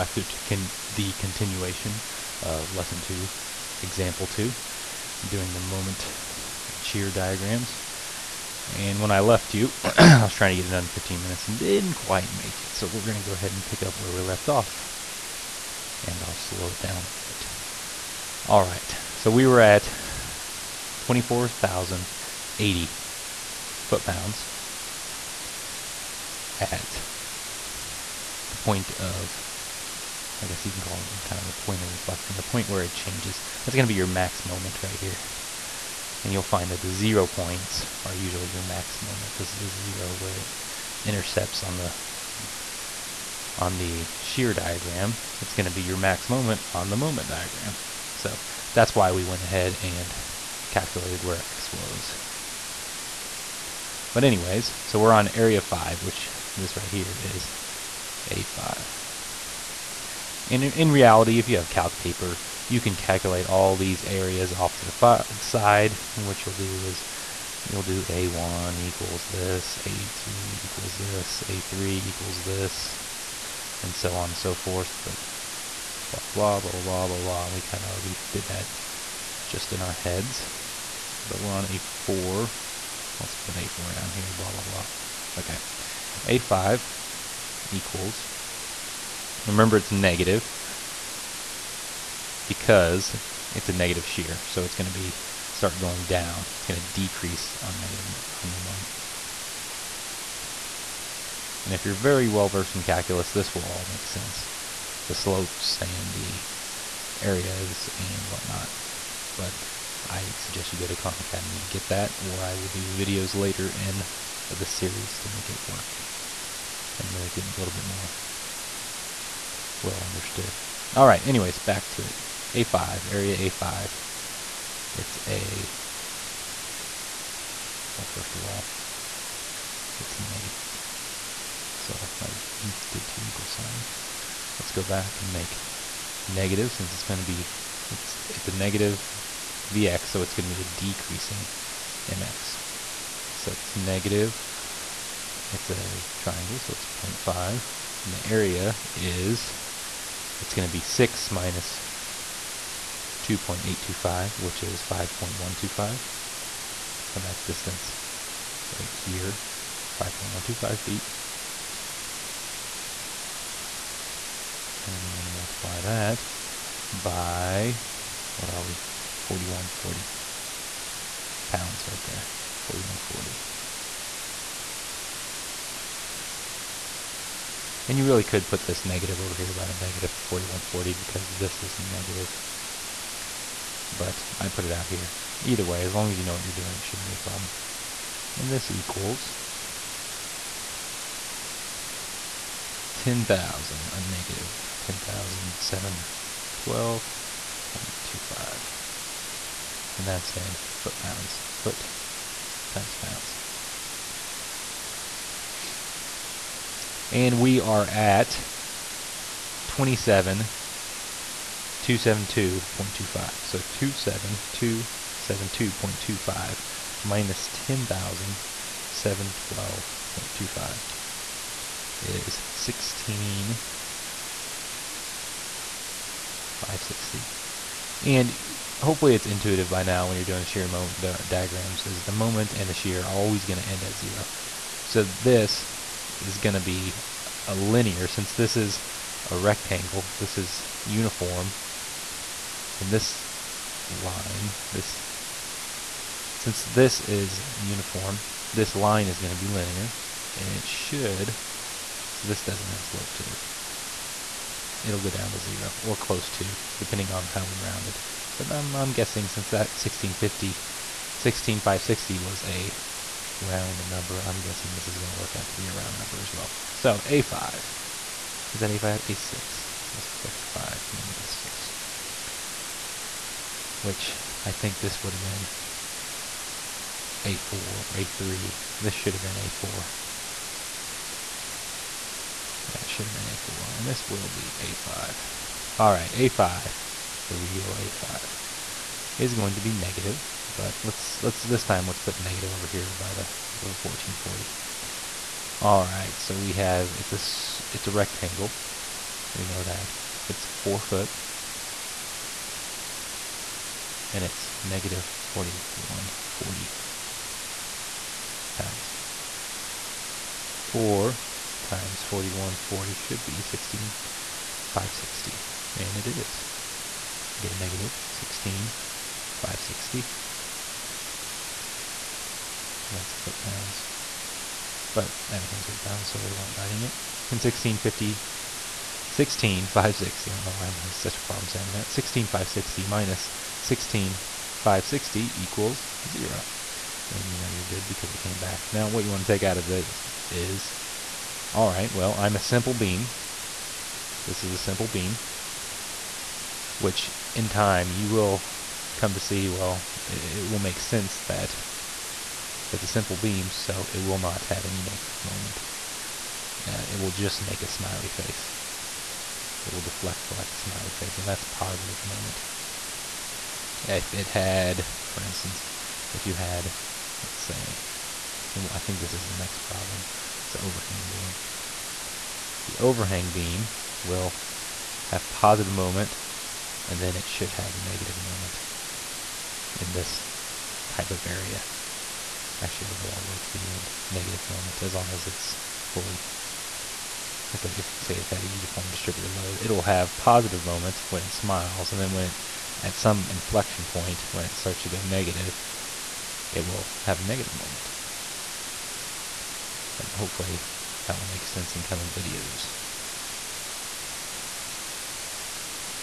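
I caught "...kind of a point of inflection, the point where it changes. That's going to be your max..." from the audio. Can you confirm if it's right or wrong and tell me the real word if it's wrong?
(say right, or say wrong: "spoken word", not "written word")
right.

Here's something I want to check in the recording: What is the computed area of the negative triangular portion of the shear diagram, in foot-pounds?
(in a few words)
-10,712.25.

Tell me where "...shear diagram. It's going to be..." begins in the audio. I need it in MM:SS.
00:44.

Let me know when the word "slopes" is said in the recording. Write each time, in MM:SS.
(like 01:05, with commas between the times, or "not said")
01:45, 04:12.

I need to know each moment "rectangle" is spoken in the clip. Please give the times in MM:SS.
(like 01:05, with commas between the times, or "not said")
03:59, 04:57.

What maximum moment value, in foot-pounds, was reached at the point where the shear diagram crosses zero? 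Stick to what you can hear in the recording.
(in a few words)
24,080 foot-pounds.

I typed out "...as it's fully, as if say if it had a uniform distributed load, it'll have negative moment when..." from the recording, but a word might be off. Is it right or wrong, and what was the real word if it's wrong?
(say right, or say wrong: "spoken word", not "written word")
wrong: "positive", not "negative".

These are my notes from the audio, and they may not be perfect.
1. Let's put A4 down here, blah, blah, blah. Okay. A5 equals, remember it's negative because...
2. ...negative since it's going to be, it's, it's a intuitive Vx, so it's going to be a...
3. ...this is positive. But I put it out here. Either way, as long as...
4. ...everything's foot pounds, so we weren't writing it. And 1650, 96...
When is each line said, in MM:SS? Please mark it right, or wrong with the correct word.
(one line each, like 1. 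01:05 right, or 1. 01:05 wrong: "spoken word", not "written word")
1. 01:23 right
2. 02:16 wrong: "negative", not "intuitive"
3. 03:01 wrong: "negative", not "positive"
4. 05:25 wrong: "16", not "96".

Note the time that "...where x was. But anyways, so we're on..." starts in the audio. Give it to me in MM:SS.
00:51.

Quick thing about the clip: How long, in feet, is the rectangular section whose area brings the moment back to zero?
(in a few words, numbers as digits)
4 feet.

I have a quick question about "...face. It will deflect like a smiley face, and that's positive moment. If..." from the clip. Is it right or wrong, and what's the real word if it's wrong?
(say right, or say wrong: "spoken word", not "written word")
right.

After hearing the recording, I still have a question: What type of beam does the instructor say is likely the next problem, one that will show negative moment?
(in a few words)
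overhanging beam.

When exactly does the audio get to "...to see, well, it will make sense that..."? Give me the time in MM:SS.
05:49.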